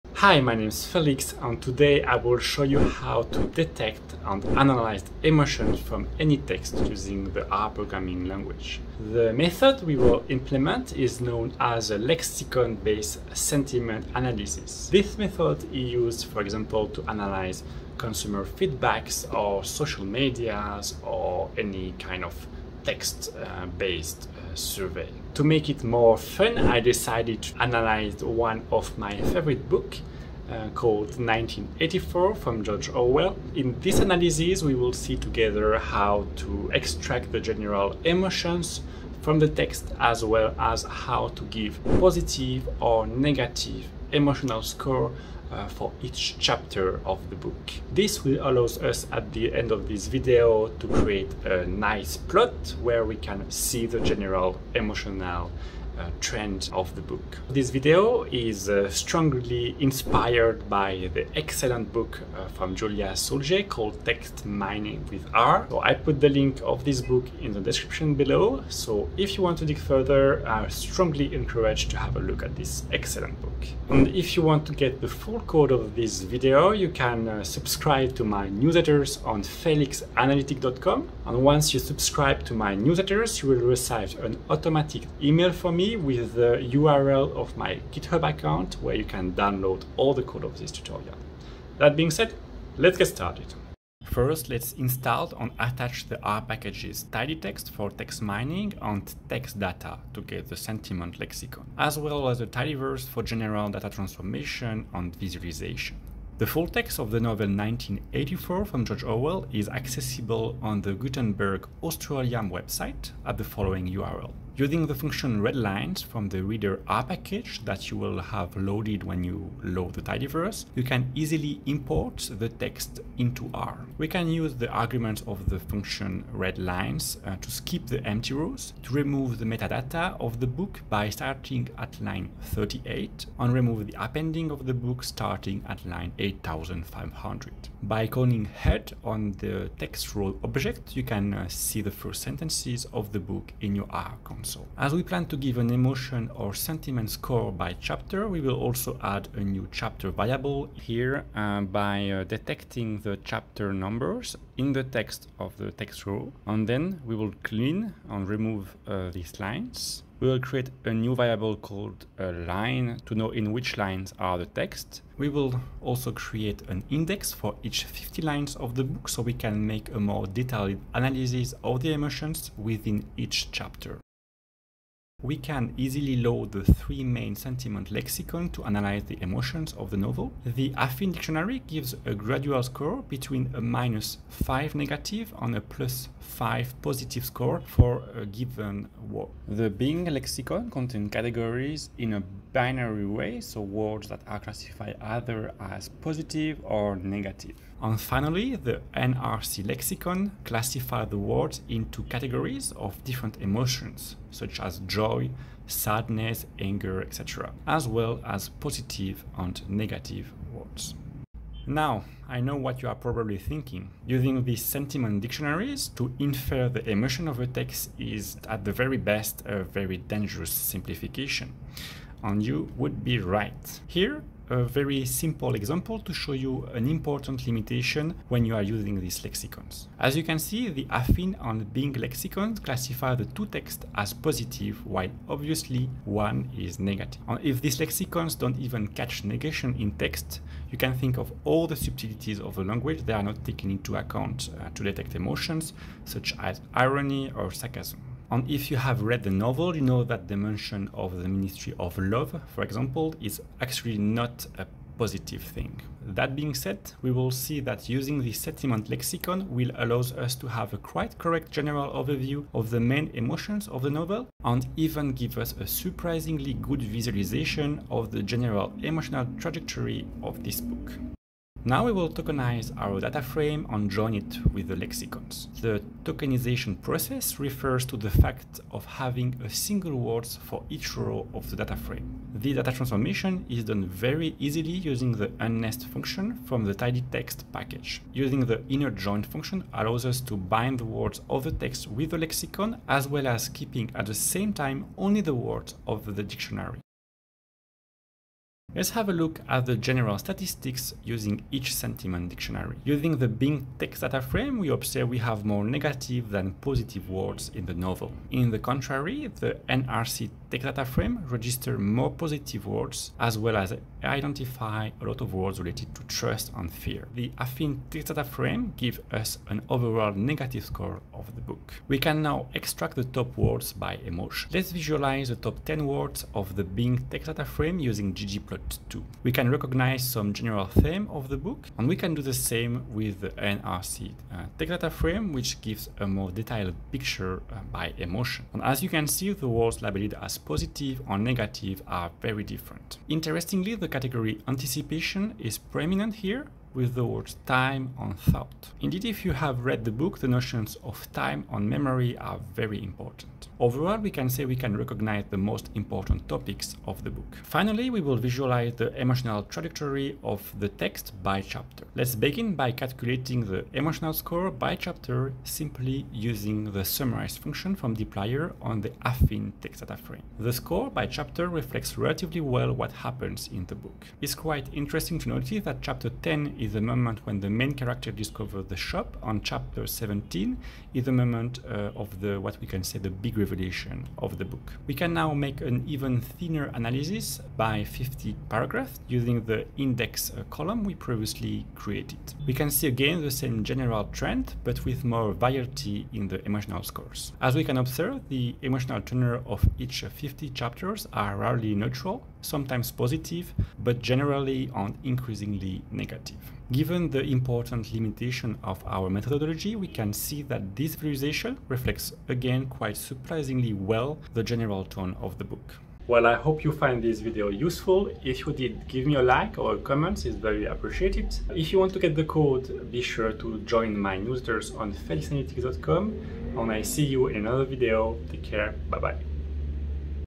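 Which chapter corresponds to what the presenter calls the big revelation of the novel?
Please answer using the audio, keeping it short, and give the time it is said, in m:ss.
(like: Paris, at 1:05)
17, at 6:19.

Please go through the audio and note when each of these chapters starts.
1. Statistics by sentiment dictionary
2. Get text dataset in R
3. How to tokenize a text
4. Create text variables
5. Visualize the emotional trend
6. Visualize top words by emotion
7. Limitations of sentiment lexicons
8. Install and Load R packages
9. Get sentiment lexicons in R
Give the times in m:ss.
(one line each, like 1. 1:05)
1. 4:57
2. 1:45
3. 4:31
4. 2:23
5. 5:57
6. 5:21
7. 3:31
8. 1:34
9. 2:54.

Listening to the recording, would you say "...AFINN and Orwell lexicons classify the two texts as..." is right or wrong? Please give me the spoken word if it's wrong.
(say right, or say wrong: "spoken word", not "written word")
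wrong: "Bing", not "Orwell".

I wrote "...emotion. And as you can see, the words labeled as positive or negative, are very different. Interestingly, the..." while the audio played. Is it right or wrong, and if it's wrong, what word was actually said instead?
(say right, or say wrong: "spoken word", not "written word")
right.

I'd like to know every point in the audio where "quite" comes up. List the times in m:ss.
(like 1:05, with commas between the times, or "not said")
4:20, 6:14, 6:52.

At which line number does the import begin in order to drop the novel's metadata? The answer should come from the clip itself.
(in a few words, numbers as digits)
38.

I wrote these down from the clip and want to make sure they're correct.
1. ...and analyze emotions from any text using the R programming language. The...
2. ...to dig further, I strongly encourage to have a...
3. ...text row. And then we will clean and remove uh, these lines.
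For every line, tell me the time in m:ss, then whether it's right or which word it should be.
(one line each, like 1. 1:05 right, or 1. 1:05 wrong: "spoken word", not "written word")
1. 0:04 right
2. 1:09 right
3. 2:35 right.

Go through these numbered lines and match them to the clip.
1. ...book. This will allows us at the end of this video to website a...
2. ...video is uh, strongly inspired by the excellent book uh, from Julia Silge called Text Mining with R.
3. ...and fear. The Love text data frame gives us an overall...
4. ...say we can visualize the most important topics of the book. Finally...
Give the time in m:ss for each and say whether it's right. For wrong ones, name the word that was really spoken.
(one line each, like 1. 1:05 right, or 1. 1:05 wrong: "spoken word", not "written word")
1. 0:47 wrong: "create", not "website"
2. 0:57 right
3. 5:16 wrong: "AFINN", not "Love"
4. 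5:54 wrong: "recognize", not "visualize".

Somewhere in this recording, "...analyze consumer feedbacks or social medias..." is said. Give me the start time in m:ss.
0:17.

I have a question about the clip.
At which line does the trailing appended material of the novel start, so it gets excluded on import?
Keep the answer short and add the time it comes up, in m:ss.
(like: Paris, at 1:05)
8500, at 2:16.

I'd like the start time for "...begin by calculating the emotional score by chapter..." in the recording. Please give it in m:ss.
6:02.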